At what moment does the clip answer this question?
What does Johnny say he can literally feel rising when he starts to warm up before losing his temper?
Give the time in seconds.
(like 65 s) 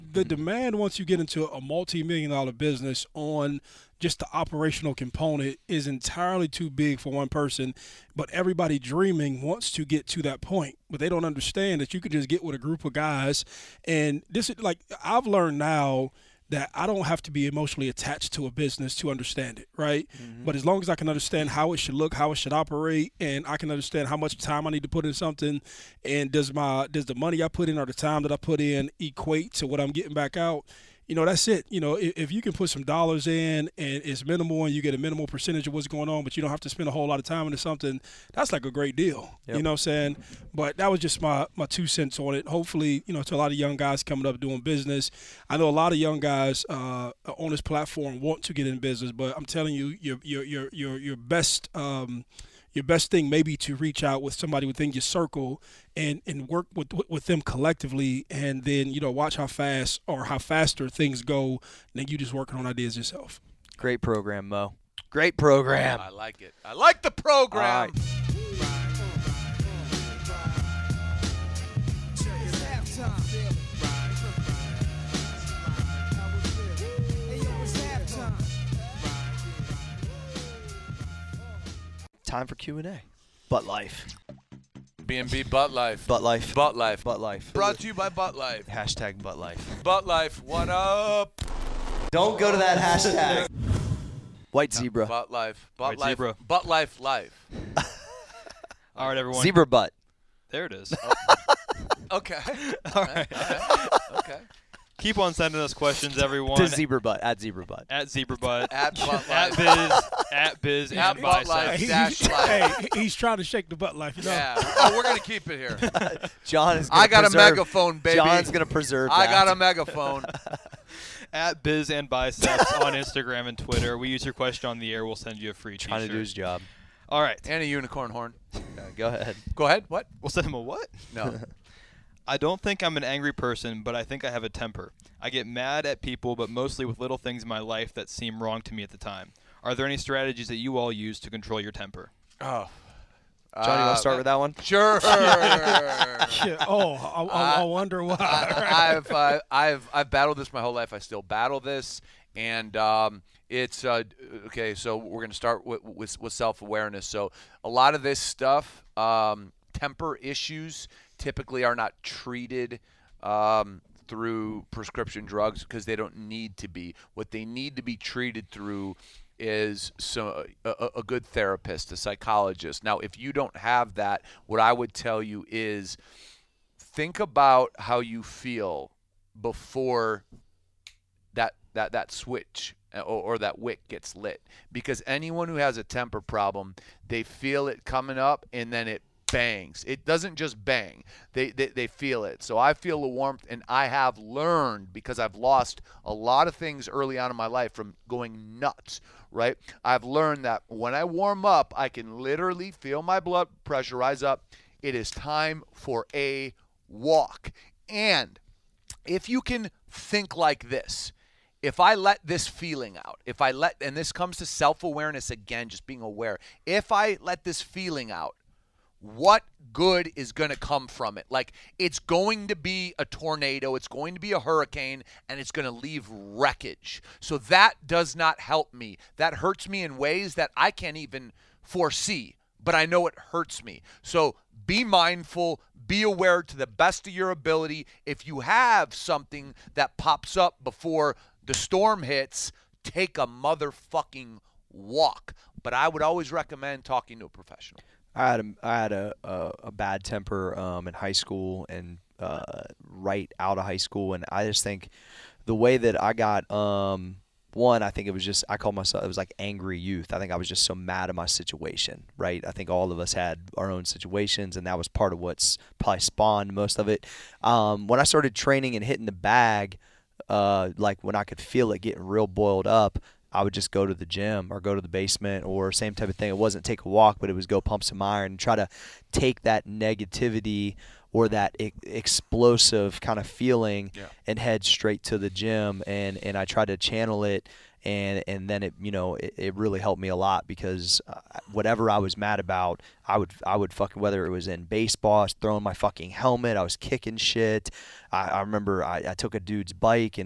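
203 s.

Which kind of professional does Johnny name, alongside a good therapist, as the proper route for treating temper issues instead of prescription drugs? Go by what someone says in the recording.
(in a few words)
psychologist.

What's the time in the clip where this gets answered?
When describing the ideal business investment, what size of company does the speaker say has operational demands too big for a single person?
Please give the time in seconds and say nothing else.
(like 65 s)
1 s.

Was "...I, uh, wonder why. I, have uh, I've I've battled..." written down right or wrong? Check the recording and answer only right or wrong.
right.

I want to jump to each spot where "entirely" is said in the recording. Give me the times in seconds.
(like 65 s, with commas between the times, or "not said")
5 s.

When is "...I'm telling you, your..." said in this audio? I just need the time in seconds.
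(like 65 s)
49 s.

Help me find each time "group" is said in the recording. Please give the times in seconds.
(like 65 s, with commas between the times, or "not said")
12 s.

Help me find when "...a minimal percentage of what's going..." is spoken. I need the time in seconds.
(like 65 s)
34 s.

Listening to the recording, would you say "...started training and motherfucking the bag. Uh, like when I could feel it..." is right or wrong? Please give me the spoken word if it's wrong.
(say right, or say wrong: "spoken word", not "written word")
wrong: "hitting", not "motherfucking".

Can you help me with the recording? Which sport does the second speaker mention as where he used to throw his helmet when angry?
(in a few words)
baseball.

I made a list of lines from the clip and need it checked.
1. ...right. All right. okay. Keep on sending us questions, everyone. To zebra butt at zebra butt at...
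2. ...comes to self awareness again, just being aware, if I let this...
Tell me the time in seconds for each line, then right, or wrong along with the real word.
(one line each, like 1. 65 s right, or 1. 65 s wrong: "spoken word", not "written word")
1. 103 s right
2. 214 s right.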